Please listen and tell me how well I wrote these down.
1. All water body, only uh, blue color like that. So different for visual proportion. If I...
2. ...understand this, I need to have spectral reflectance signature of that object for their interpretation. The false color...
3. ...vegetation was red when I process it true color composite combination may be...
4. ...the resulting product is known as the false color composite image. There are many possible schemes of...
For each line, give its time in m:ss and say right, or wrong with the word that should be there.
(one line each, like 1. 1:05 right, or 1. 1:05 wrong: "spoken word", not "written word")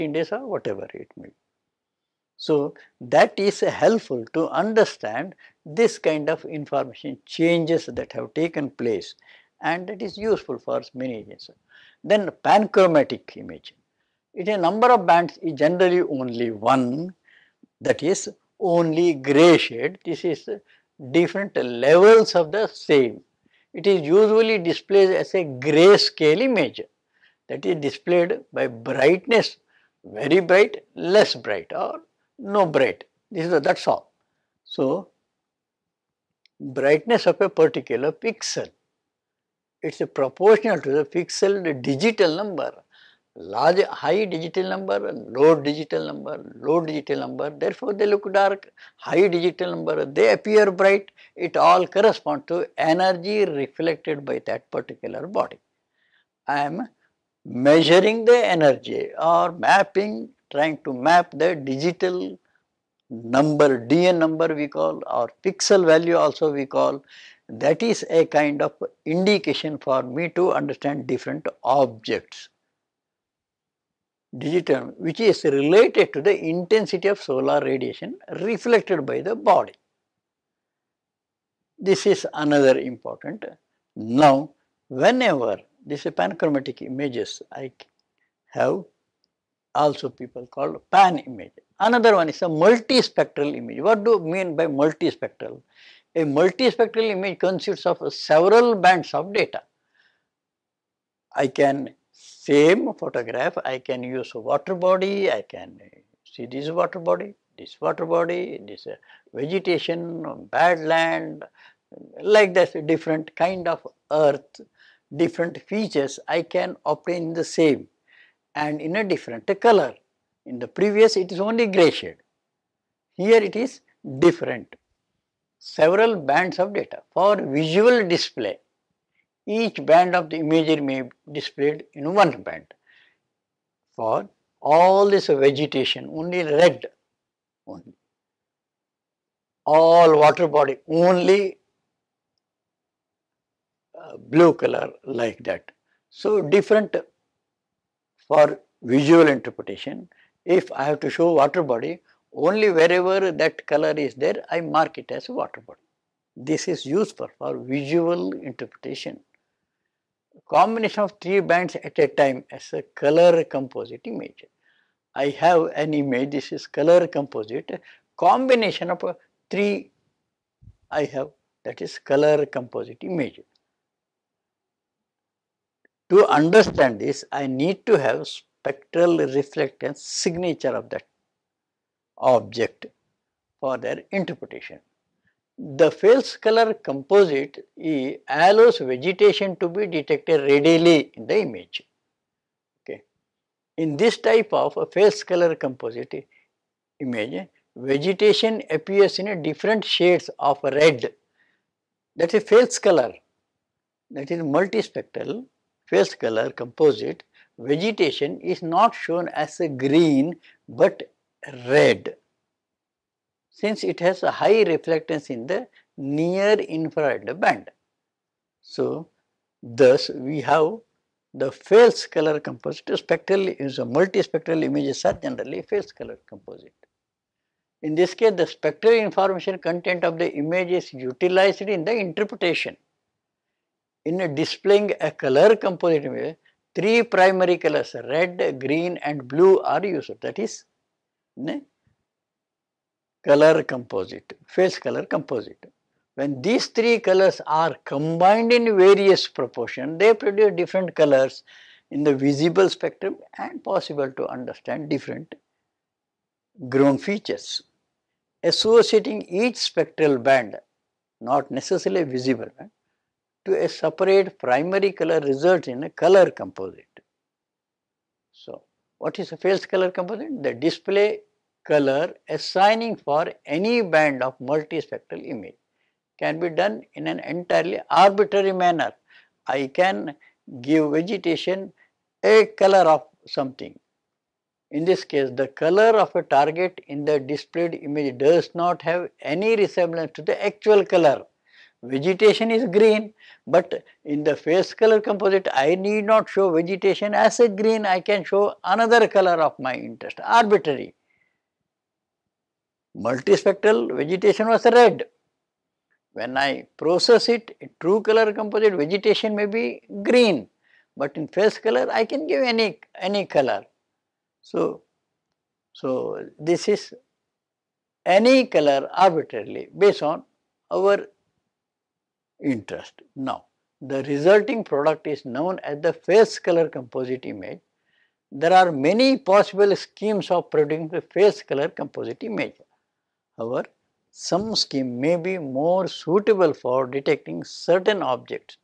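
1. 2:19 wrong: "interpretation", not "proportion"
2. 2:56 right
3. 5:03 wrong: "vegetation", not "combination"
4. 5:23 right.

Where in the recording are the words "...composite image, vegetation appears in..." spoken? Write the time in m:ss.
3:15.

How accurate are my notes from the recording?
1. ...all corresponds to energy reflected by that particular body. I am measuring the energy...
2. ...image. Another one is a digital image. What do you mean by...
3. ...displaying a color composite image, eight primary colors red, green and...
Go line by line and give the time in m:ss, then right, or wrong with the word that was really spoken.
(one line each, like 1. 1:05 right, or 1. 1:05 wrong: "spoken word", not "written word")
1. 0:51 right
2. 1:31 wrong: "multispectral", not "digital"
3. 3:54 wrong: "three", not "eight".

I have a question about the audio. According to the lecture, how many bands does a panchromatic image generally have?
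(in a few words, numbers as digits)
1.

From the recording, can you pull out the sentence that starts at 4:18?
Associating each spectral band, not necessarily visible band, to a separate primary color results in a color composite.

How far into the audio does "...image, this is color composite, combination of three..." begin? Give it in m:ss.
2:45.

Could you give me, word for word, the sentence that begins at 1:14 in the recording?
Digital, which is related to the intensity of solar radiation reflected by the body.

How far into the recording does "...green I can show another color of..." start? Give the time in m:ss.
4:57.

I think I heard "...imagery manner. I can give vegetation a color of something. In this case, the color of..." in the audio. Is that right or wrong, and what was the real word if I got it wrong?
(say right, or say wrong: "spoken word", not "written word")
wrong: "arbitrary", not "imagery".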